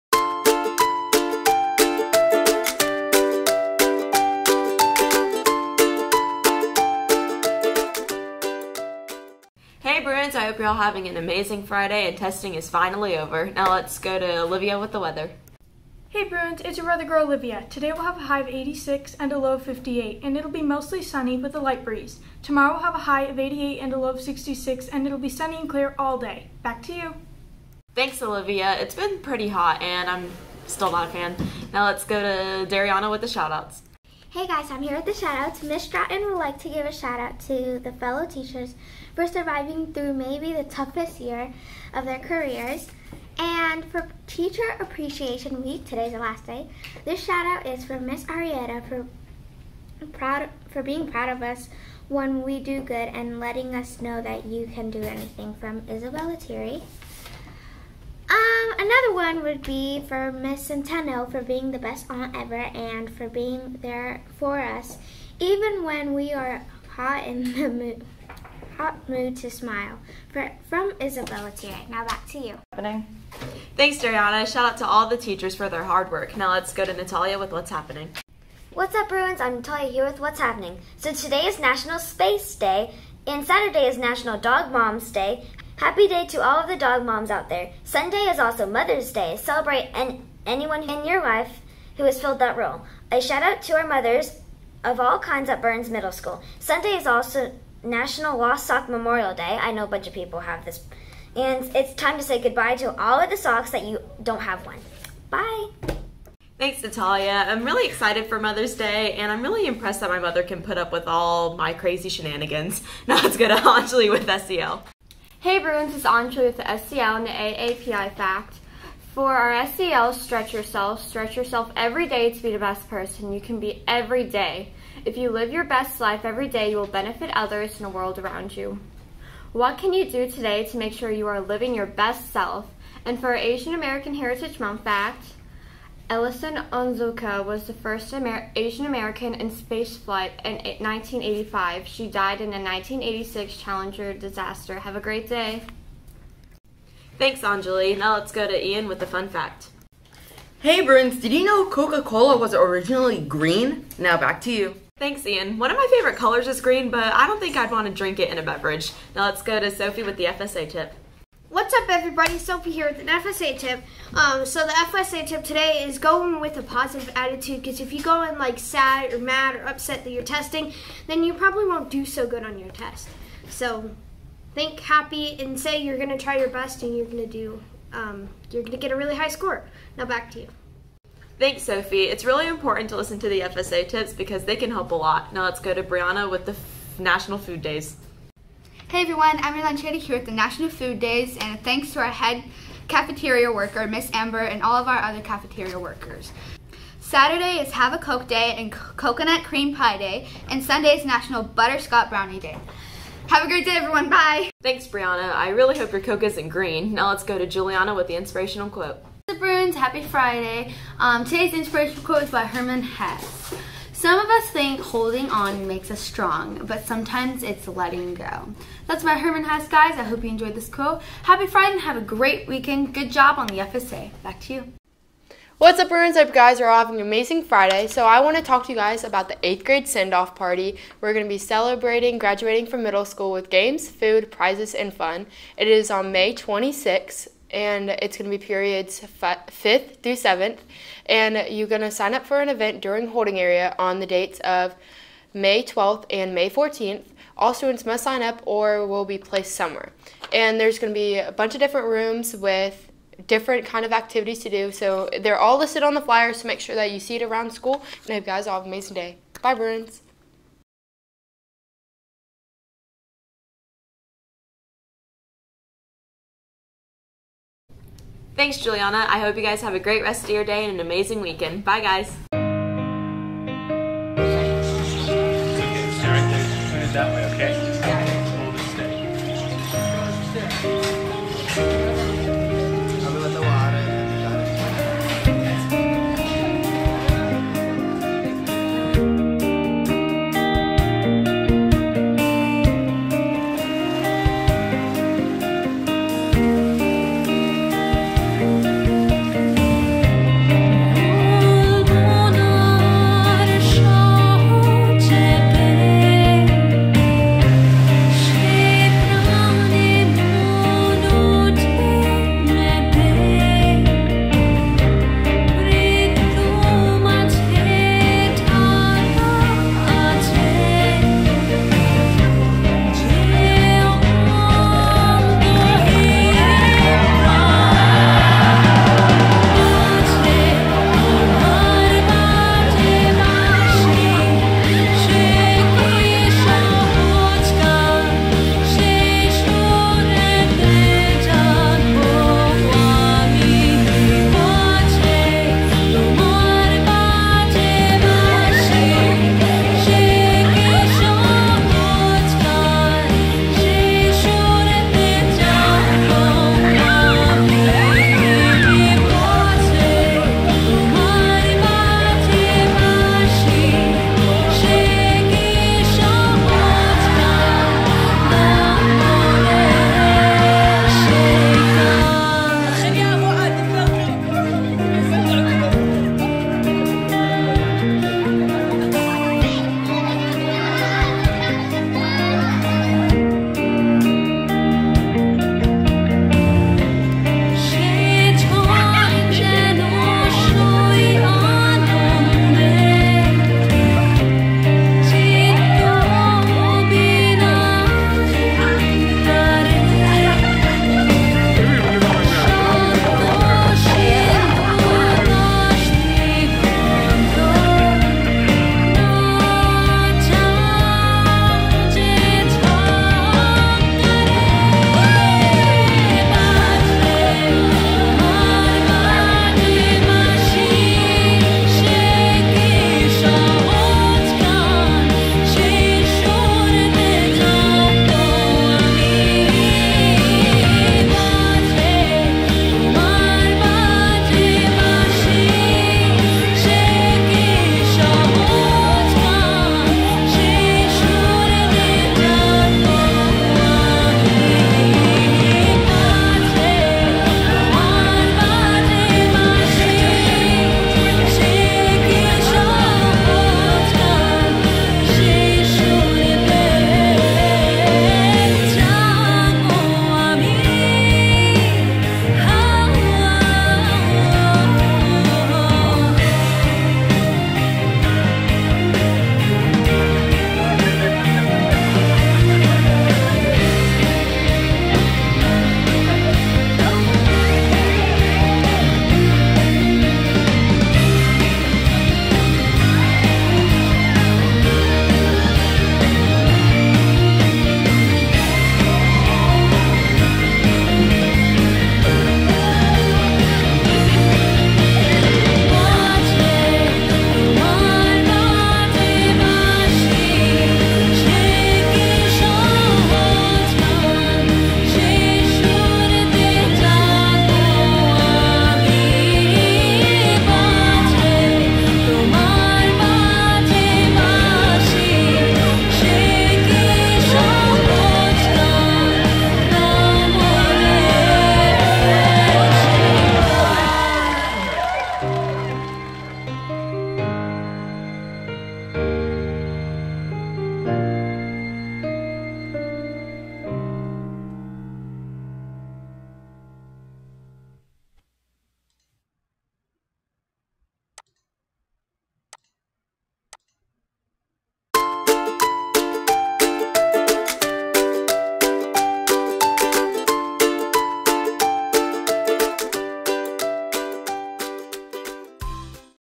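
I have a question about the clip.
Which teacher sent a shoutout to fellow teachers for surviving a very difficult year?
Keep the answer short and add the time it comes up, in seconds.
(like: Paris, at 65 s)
Ms. Stratton, at 35 s.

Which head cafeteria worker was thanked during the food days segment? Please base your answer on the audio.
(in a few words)
Miss Amber.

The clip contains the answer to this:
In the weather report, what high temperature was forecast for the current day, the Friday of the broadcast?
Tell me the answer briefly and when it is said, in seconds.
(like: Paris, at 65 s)
86, at 18 s.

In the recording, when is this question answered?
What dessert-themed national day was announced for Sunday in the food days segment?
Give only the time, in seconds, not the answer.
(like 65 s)
201 s.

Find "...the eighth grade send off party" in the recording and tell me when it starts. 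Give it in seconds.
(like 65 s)
229 s.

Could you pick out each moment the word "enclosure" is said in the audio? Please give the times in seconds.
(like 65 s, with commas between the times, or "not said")
not said.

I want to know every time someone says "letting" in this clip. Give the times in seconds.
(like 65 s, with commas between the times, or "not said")
53 s, 217 s.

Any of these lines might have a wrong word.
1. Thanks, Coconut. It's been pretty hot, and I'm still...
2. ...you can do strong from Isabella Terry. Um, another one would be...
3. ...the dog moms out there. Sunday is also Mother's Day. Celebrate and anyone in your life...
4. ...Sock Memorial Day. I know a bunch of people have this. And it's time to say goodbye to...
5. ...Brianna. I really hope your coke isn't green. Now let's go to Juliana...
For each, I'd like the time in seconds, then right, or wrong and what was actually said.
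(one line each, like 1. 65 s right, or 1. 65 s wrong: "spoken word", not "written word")
1. 27 s wrong: "Olivia", not "Coconut"
2. 54 s wrong: "anything", not "strong"
3. 86 s right
4. 98 s right
5. 204 s right.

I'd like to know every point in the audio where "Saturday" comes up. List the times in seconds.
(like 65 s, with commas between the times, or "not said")
83 s, 196 s.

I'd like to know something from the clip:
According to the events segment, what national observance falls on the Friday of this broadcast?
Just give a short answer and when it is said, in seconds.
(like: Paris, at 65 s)
National Space Day, at 81 s.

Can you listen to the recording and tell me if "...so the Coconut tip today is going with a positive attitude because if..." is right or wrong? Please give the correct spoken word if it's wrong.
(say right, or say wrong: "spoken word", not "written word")
wrong: "FSA", not "Coconut".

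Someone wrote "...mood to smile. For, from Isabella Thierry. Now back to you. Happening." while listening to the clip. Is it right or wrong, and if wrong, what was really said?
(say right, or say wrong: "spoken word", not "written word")
right.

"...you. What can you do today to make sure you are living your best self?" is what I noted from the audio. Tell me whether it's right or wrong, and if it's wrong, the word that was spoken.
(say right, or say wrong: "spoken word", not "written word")
right.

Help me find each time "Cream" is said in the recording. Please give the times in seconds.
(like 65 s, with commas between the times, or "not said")
199 s.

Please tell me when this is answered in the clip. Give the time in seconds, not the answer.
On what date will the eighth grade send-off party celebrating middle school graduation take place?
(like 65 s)
236 s.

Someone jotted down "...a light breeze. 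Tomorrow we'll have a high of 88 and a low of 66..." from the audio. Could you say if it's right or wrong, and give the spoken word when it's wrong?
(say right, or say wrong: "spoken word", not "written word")
right.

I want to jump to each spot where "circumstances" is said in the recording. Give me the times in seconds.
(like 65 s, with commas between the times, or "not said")
not said.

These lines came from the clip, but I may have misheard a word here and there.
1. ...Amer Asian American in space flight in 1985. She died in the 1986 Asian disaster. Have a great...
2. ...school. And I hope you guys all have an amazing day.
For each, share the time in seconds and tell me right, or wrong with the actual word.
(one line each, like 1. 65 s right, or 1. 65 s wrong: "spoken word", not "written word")
1. 138 s wrong: "Challenger", not "Asian"
2. 257 s right.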